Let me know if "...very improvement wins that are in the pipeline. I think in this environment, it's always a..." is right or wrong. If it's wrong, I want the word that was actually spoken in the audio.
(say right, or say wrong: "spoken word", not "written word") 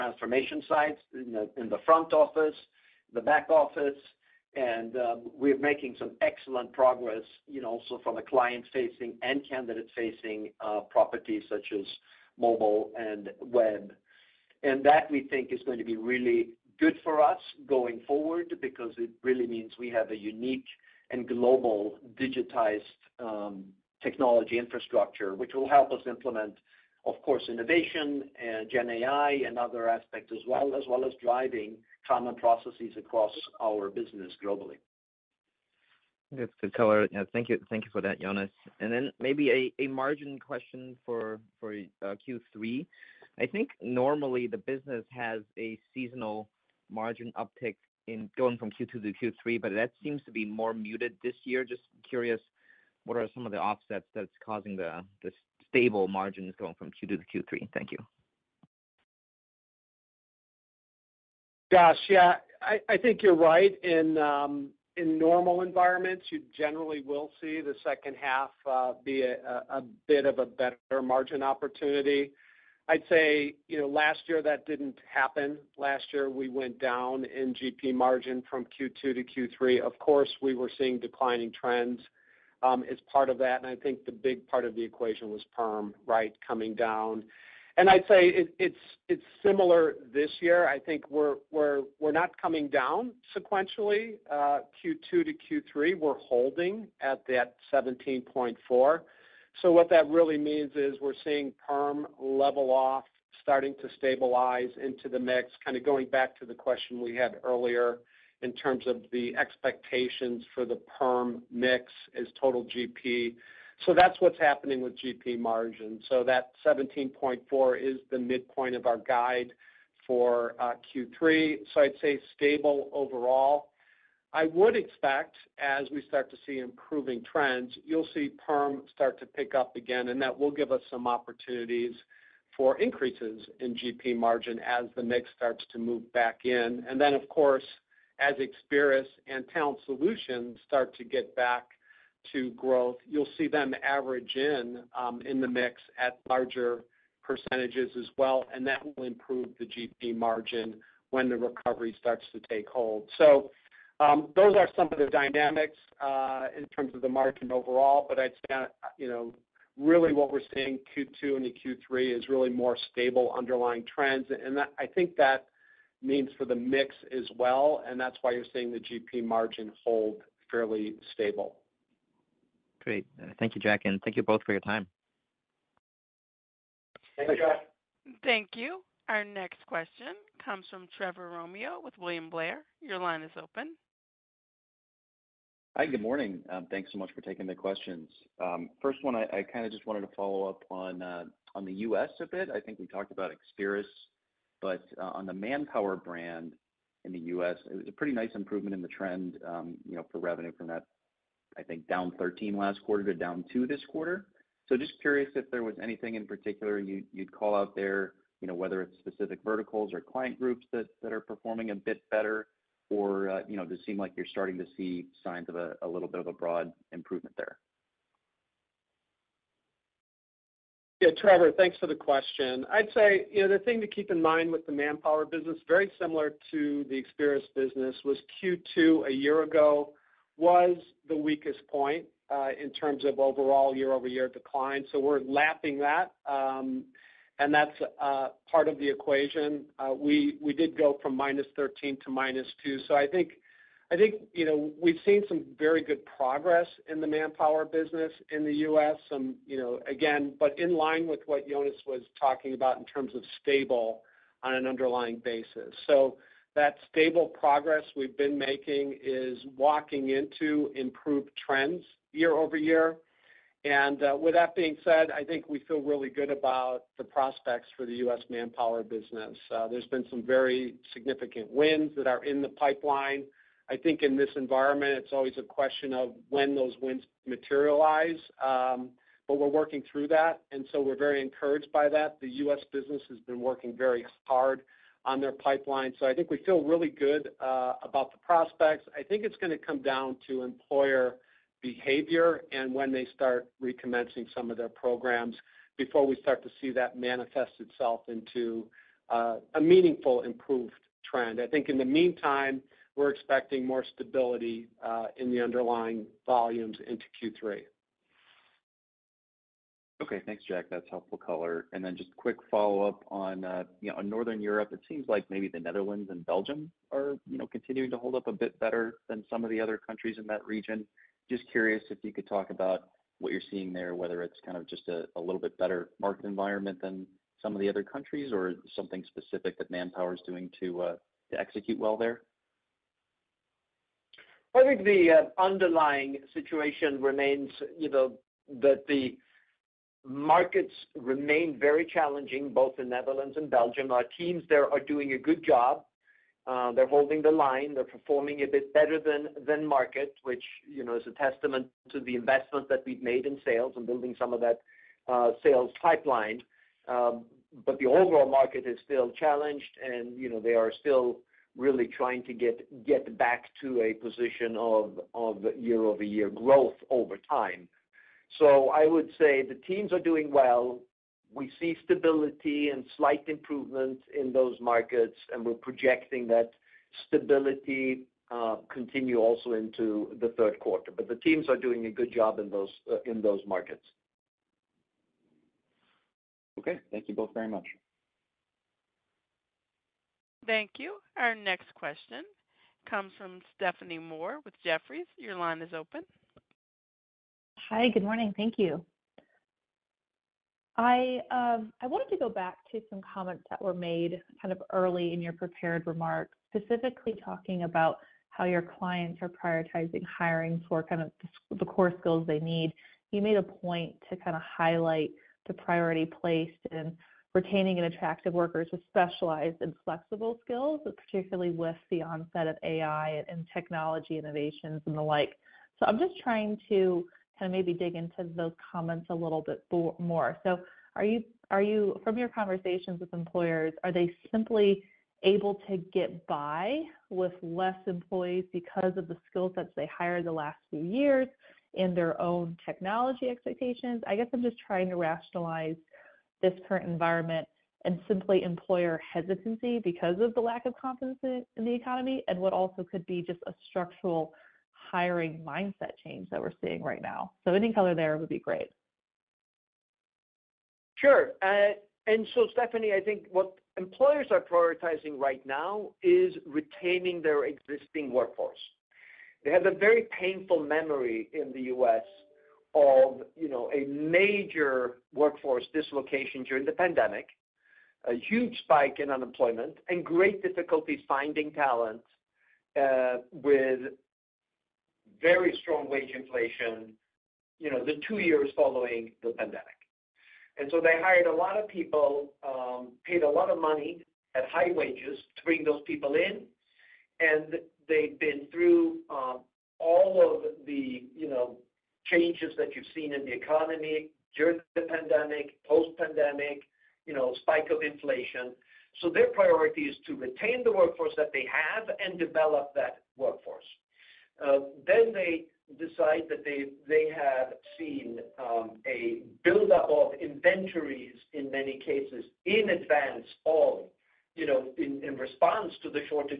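wrong: "significant", not "improvement".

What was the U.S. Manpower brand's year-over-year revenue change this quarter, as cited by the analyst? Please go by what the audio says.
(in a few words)
down 2.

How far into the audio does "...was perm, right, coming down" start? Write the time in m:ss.
1:25.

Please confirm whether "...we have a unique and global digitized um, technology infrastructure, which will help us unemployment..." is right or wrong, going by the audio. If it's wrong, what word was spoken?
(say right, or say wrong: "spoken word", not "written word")
wrong: "implement", not "unemployment".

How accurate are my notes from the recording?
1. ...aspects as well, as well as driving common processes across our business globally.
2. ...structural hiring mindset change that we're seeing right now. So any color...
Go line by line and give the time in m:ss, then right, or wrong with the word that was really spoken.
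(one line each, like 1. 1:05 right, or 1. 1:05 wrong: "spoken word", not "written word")
1. 0:29 right
2. 7:33 right.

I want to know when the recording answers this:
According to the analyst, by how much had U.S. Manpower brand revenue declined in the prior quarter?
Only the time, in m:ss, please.
3:21.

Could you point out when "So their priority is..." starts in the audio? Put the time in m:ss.
8:29.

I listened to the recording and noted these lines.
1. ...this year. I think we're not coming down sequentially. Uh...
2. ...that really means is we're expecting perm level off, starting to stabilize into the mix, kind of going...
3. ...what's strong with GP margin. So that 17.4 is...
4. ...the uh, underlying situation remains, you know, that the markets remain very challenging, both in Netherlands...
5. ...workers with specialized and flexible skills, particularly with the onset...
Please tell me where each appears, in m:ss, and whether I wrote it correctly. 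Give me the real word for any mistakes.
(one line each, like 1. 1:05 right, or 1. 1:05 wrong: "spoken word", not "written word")
1. 1:30 right
2. 1:39 wrong: "seeing", not "expecting"
3. 1:54 wrong: "happening", not "strong"
4. 5:34 right
5. 6:58 right.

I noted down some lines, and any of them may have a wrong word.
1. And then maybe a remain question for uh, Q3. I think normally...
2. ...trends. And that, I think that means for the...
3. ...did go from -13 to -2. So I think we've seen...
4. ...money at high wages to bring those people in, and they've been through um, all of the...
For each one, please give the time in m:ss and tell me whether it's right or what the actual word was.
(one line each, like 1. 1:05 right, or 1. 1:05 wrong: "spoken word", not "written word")
1. 0:38 wrong: "margin", not "remain"
2. 2:43 right
3. 4:00 right
4. 8:13 right.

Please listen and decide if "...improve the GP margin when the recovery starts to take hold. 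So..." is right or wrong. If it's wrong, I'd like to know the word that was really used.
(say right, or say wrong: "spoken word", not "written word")
right.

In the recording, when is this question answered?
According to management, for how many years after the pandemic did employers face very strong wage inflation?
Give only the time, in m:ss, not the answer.
8:08.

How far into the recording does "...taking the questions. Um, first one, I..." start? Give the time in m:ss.
3:07.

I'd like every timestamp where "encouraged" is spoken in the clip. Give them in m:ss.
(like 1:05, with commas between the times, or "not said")
4:41.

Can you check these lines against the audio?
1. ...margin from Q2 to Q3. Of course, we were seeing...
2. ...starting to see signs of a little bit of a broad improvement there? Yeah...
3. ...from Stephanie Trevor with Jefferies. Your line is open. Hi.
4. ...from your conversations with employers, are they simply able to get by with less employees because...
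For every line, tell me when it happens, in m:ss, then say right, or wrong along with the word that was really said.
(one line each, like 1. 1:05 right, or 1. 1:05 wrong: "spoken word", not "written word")
1. 1:17 right
2. 3:34 right
3. 6:33 wrong: "Moore", not "Trevor"
4. 7:12 right.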